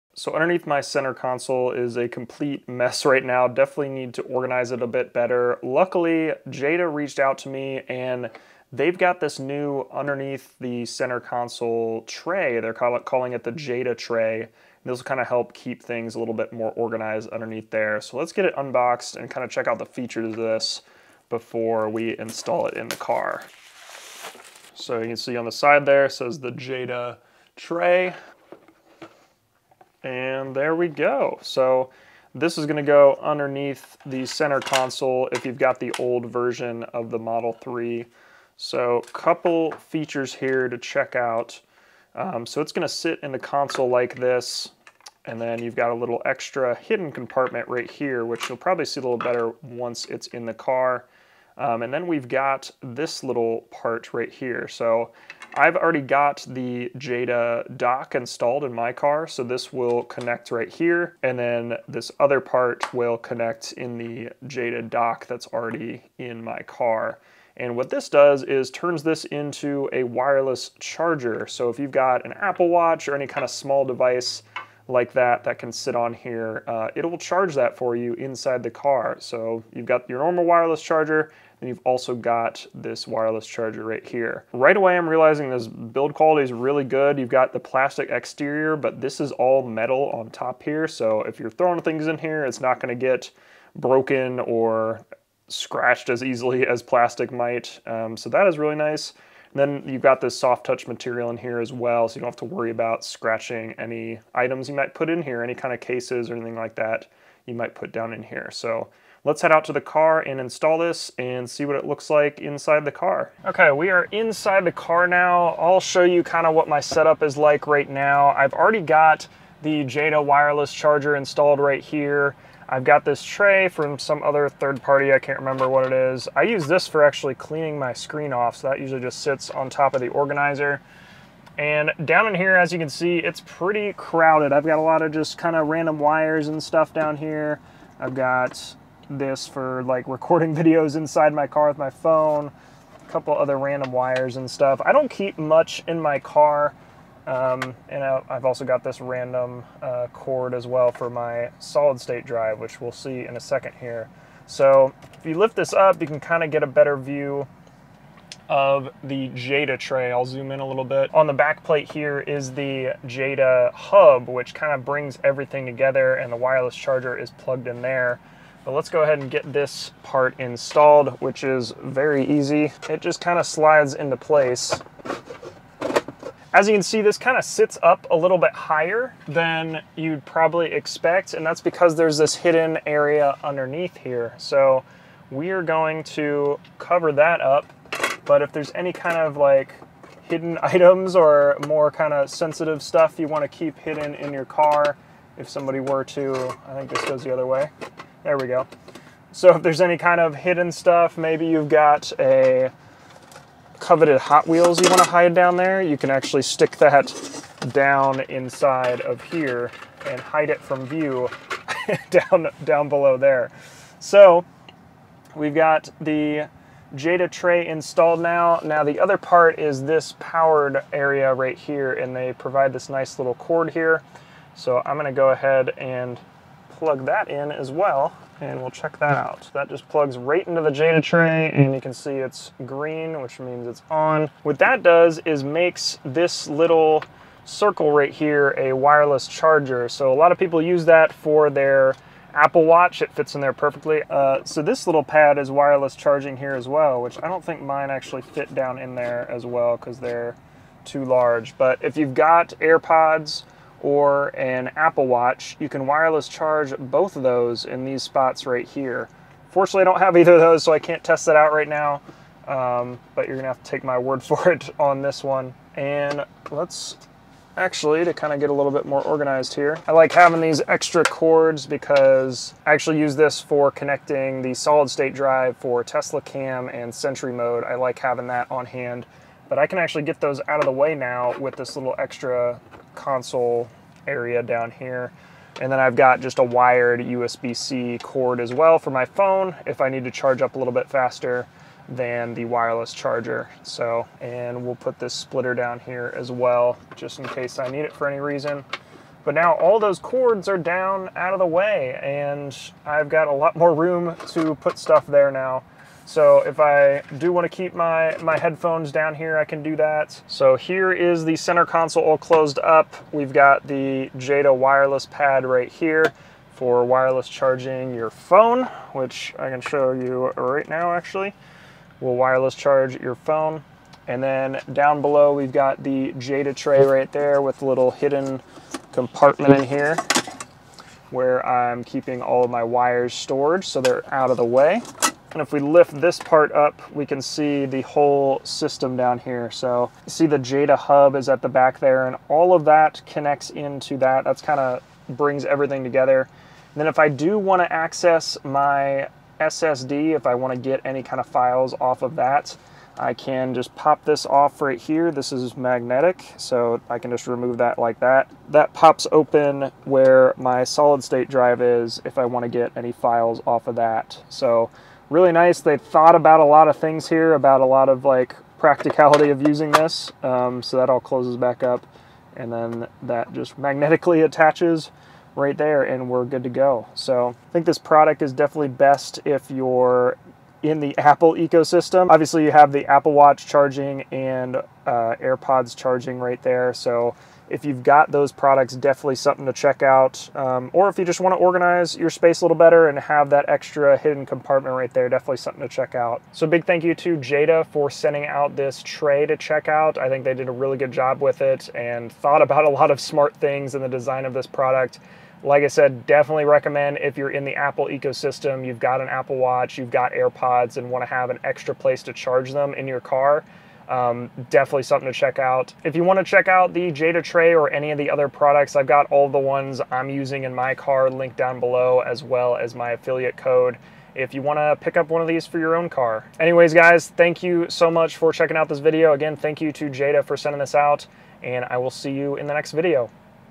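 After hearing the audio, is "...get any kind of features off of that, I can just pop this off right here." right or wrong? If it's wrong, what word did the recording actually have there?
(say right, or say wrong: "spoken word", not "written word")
wrong: "files", not "features".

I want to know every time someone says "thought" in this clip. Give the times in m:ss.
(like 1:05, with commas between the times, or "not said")
6:05, 6:42.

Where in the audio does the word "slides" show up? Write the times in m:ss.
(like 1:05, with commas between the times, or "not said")
2:53.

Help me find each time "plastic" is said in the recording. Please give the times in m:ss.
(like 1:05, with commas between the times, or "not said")
1:27, 1:36.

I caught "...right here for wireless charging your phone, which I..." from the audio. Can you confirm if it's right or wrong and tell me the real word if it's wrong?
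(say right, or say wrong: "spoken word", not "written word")
right.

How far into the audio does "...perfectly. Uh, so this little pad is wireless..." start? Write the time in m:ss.
4:03.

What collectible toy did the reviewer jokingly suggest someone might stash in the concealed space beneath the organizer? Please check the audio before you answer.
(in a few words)
Hot Wheels.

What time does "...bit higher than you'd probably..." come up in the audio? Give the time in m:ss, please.
2:58.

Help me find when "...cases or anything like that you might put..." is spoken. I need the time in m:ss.
1:45.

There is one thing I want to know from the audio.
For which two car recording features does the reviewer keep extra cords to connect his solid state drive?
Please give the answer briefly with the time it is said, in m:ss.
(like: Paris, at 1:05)
Tesla cam and Sentry mode, at 4:35.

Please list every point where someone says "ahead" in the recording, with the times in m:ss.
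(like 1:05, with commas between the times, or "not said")
2:49, 3:45.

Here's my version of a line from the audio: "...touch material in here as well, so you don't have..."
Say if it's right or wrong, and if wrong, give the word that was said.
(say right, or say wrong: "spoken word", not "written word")
right.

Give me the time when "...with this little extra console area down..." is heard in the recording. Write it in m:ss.
4:41.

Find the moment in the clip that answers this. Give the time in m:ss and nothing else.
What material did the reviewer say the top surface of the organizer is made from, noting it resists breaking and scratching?
1:29.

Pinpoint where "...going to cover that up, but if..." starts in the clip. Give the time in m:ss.
3:05.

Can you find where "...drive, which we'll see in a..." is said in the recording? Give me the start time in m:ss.
2:32.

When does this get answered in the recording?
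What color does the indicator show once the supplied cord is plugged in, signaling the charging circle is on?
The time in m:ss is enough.
3:52.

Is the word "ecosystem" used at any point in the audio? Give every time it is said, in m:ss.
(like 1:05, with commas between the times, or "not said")
6:21, 6:47.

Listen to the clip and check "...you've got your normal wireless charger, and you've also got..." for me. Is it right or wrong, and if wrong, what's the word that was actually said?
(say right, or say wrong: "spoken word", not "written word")
right.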